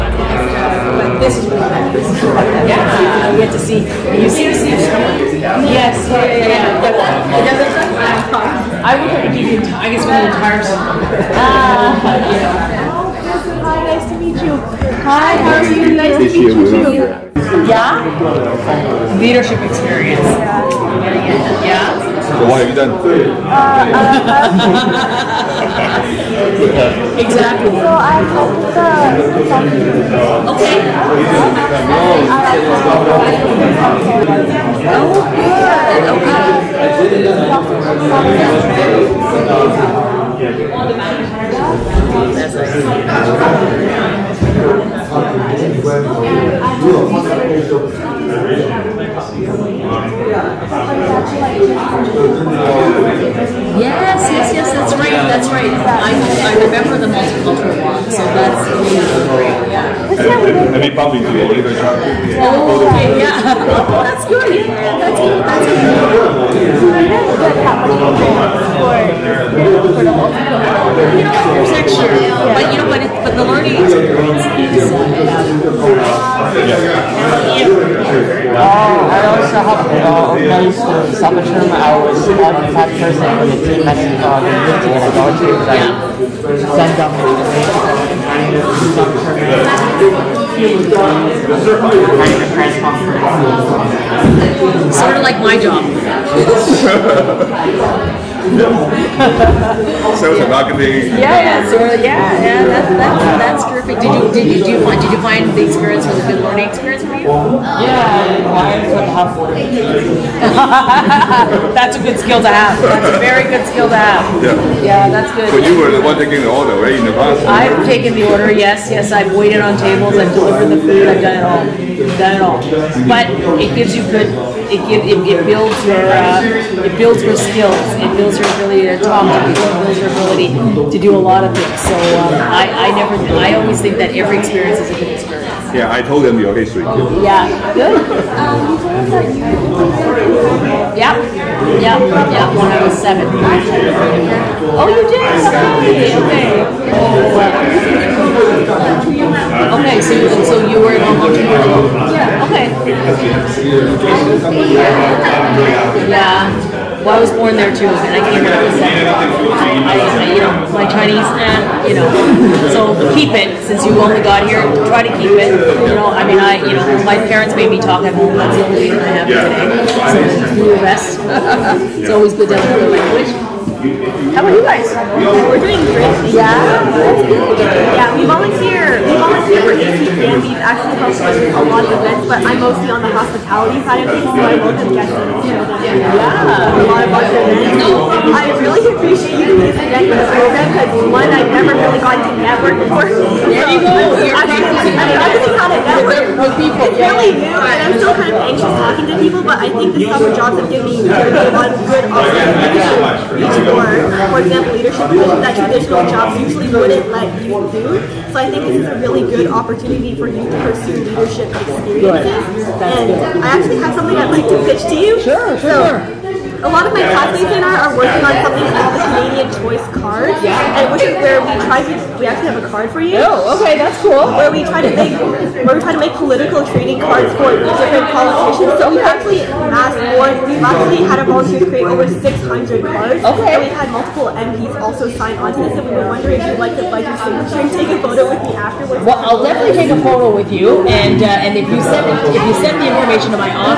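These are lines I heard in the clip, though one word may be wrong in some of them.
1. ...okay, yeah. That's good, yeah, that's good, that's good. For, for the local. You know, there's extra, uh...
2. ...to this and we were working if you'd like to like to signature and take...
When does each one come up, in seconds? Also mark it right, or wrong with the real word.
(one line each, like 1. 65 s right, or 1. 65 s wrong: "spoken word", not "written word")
1. 62 s wrong: "multicultural", not "local"
2. 235 s wrong: "wondering", not "working".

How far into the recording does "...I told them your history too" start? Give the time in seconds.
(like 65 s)
135 s.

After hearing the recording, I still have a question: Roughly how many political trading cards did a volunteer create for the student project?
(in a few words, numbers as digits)
600.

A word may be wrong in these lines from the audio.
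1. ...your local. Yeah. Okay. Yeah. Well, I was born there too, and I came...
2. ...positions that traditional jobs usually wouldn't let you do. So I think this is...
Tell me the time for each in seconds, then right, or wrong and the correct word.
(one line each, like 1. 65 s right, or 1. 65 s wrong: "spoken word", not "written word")
1. 151 s right
2. 205 s right.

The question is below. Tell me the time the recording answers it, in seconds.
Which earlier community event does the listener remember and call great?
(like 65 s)
57 s.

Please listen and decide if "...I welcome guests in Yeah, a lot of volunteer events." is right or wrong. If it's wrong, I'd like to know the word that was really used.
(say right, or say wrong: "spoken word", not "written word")
right.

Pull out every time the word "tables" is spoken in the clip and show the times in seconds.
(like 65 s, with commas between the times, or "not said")
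119 s.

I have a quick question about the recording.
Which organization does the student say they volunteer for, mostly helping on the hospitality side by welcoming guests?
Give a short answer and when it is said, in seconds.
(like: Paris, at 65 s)
ACPN, at 179 s.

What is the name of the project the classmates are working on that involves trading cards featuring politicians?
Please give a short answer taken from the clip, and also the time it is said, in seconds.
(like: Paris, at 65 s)
Canadian Choice card, at 219 s.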